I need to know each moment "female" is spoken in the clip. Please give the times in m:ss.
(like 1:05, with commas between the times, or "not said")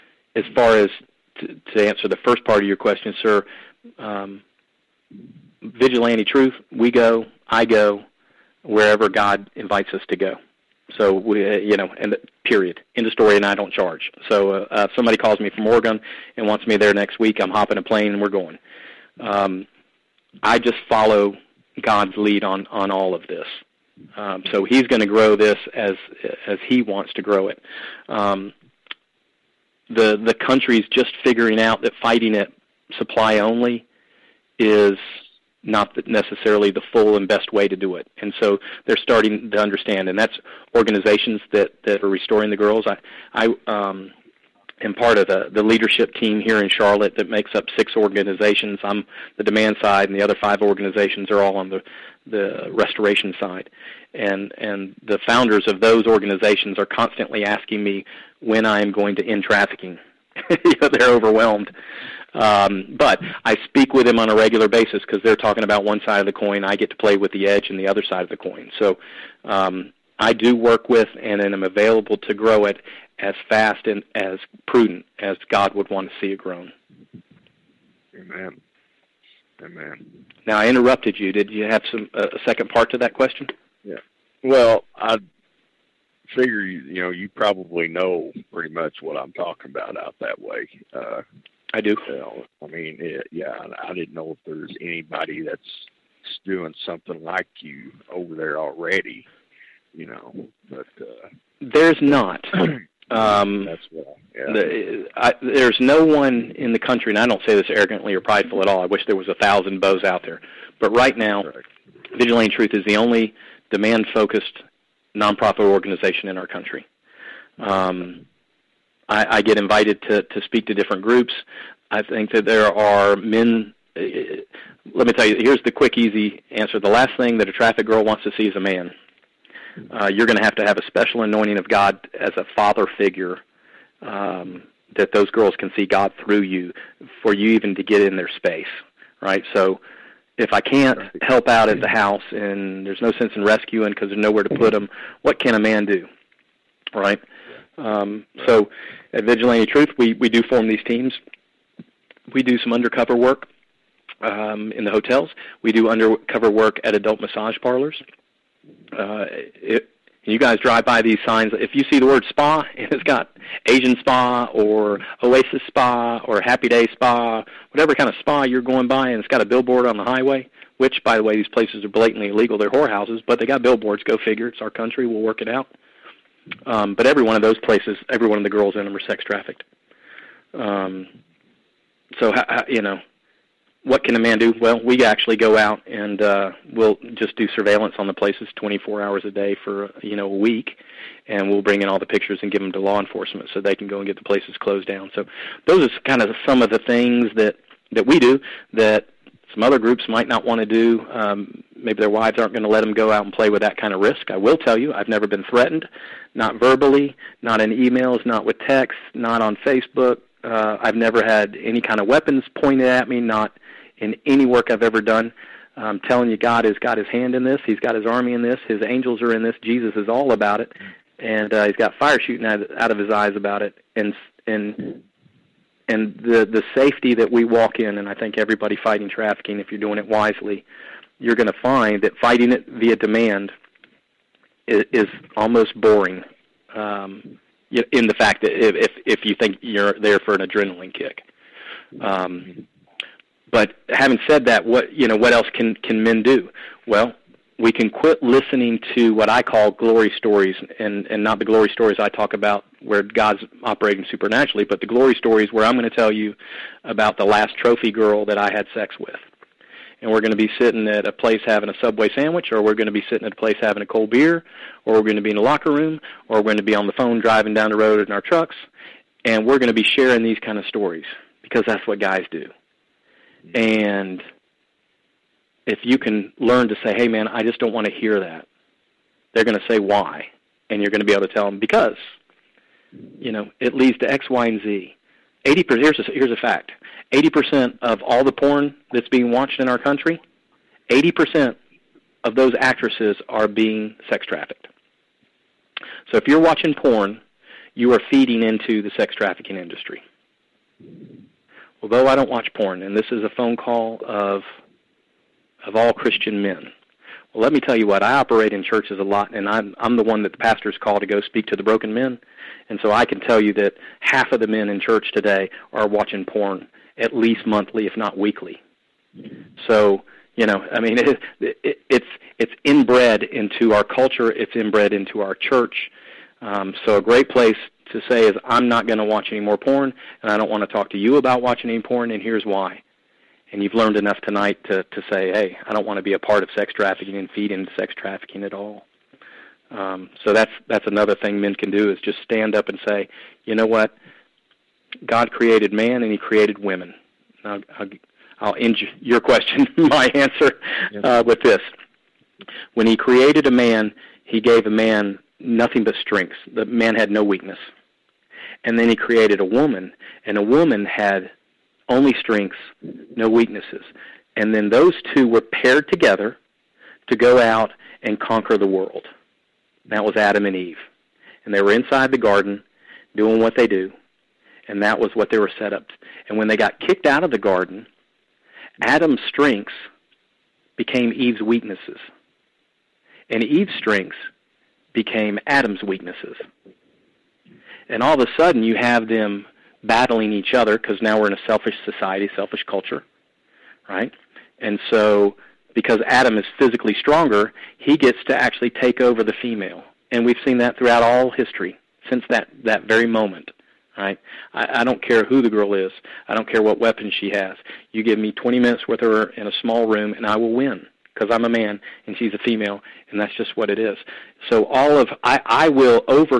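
6:39, 6:52.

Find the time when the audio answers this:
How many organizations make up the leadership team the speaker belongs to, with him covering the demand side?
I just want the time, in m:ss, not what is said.
0:47.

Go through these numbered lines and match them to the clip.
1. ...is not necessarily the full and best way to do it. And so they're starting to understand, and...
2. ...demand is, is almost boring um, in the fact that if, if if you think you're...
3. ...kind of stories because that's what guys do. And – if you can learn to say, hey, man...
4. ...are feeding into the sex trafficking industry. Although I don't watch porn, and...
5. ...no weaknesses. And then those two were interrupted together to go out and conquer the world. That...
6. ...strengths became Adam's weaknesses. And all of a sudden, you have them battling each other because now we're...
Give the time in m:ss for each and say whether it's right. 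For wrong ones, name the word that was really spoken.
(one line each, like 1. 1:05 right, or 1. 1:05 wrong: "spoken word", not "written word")
1. 0:34 right
2. 3:52 right
3. 4:30 right
4. 4:57 right
5. 6:03 wrong: "paired", not "interrupted"
6. 6:23 right.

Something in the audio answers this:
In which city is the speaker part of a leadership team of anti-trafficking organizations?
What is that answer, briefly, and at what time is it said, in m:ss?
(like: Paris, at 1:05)
Charlotte, at 0:46.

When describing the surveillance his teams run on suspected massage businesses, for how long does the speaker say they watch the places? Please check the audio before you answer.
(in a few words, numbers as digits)
a week.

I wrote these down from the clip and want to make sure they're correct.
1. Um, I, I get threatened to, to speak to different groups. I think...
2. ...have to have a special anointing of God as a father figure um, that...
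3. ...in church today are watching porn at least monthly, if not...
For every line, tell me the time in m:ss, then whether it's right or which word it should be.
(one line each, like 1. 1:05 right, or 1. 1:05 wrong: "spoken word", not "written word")
1. 1:57 wrong: "invited", not "threatened"
2. 2:10 right
3. 5:14 right.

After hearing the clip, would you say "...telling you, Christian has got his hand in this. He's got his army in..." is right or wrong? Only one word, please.
wrong.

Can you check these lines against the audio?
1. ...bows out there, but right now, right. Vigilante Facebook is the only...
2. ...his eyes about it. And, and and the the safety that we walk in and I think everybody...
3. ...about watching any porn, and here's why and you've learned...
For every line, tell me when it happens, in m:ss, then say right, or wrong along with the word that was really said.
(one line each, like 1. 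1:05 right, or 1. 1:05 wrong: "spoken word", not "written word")
1. 1:49 wrong: "Truth", not "Facebook"
2. 3:42 right
3. 5:31 right.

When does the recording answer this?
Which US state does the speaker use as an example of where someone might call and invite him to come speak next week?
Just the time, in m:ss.
0:15.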